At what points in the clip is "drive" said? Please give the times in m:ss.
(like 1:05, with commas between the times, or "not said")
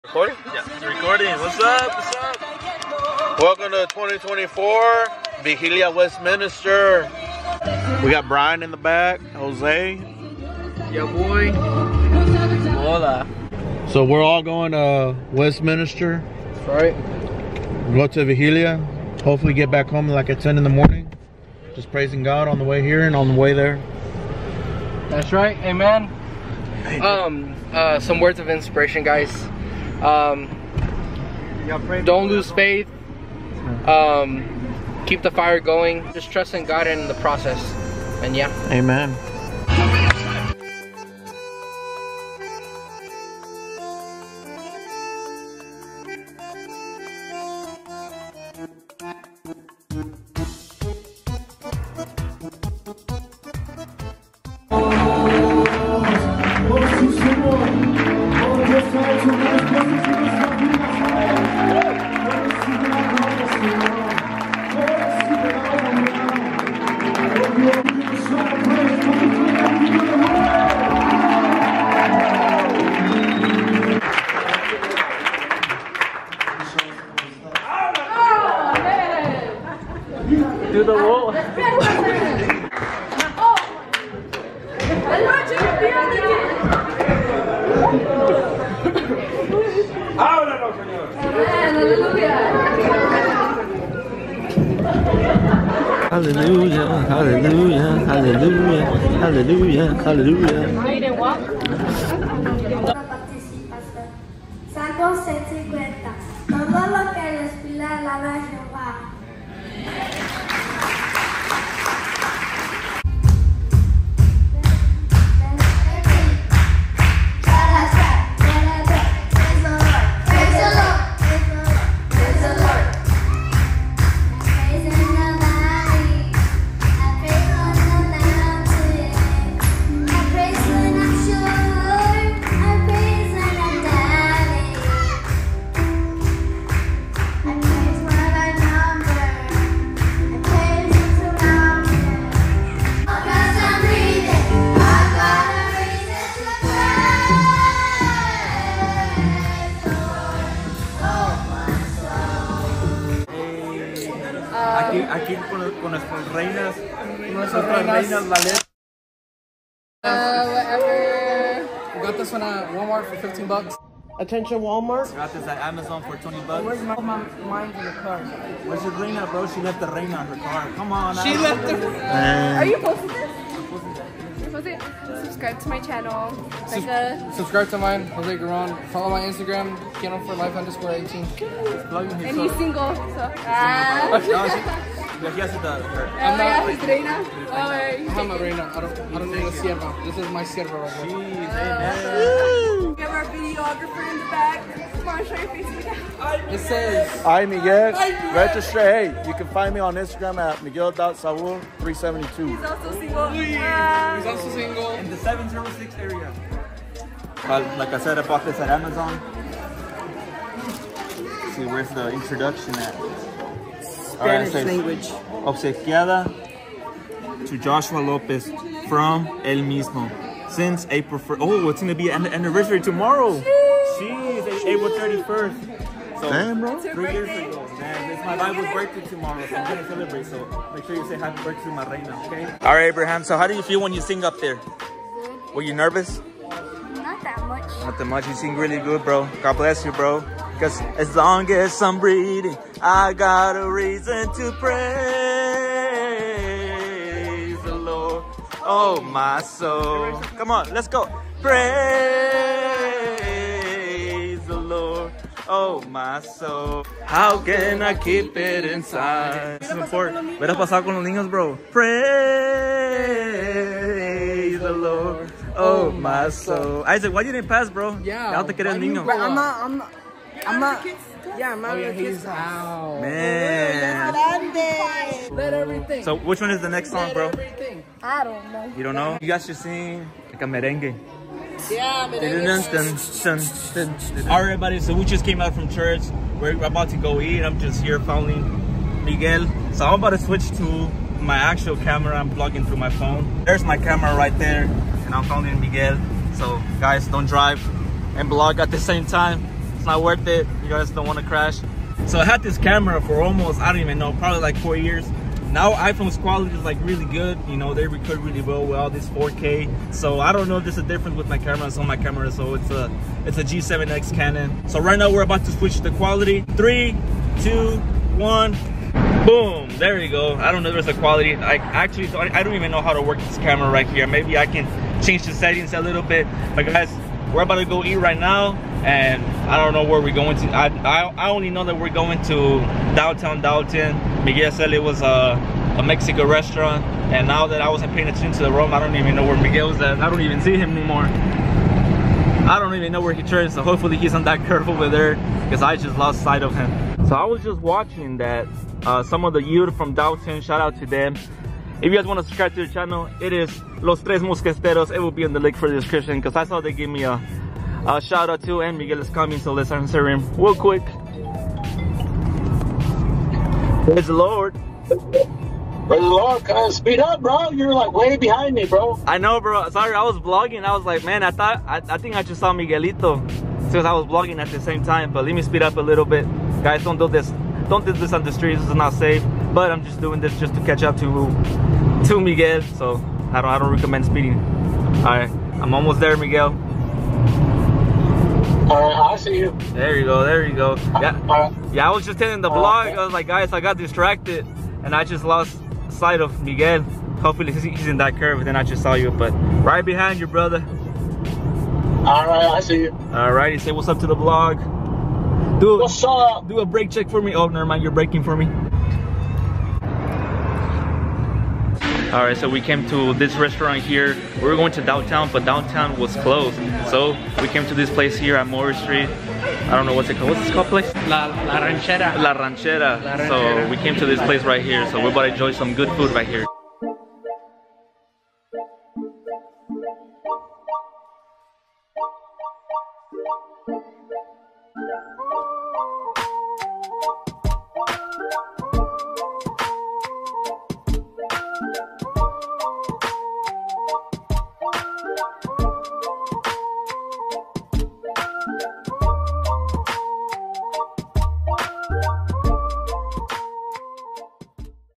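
4:57.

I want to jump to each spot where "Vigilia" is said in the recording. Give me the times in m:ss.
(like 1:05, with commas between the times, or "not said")
0:05, 0:18.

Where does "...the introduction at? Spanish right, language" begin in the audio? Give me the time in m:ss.
3:31.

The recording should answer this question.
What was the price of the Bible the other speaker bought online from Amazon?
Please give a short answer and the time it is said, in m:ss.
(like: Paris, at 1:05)
$20, at 2:46.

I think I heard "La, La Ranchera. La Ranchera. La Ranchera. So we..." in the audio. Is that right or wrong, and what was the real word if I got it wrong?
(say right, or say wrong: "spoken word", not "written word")
right.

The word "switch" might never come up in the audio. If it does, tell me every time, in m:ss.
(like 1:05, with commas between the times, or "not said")
4:50, 5:15.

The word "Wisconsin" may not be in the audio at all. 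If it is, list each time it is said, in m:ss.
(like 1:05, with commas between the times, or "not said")
not said.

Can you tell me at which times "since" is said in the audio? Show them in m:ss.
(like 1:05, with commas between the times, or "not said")
3:40, 6:13.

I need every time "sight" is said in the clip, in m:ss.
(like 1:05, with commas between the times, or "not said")
5:46, 6:35.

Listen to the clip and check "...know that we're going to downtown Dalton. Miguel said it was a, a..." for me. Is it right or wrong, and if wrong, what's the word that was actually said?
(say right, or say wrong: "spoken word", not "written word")
right.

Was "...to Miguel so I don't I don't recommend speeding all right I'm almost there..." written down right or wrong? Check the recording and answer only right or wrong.
right.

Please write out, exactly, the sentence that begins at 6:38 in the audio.
Then I just saw you, but right behind you, brother.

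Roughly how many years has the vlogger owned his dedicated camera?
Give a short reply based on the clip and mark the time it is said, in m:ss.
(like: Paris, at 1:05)
4, at 5:04.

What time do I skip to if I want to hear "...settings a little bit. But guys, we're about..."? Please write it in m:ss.
5:25.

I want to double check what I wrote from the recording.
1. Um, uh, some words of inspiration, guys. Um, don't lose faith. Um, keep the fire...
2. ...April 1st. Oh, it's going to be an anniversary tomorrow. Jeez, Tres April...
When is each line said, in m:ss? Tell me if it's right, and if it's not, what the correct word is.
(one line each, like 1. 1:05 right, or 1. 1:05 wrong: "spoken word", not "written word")
1. 0:27 right
2. 3:40 wrong: "Jeez", not "Tres".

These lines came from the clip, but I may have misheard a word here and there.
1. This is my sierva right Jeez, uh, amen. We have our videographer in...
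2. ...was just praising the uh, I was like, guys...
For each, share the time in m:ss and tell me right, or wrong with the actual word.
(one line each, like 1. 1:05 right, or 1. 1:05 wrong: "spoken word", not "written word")
1. 3:10 right
2. 6:31 wrong: "telling", not "praising".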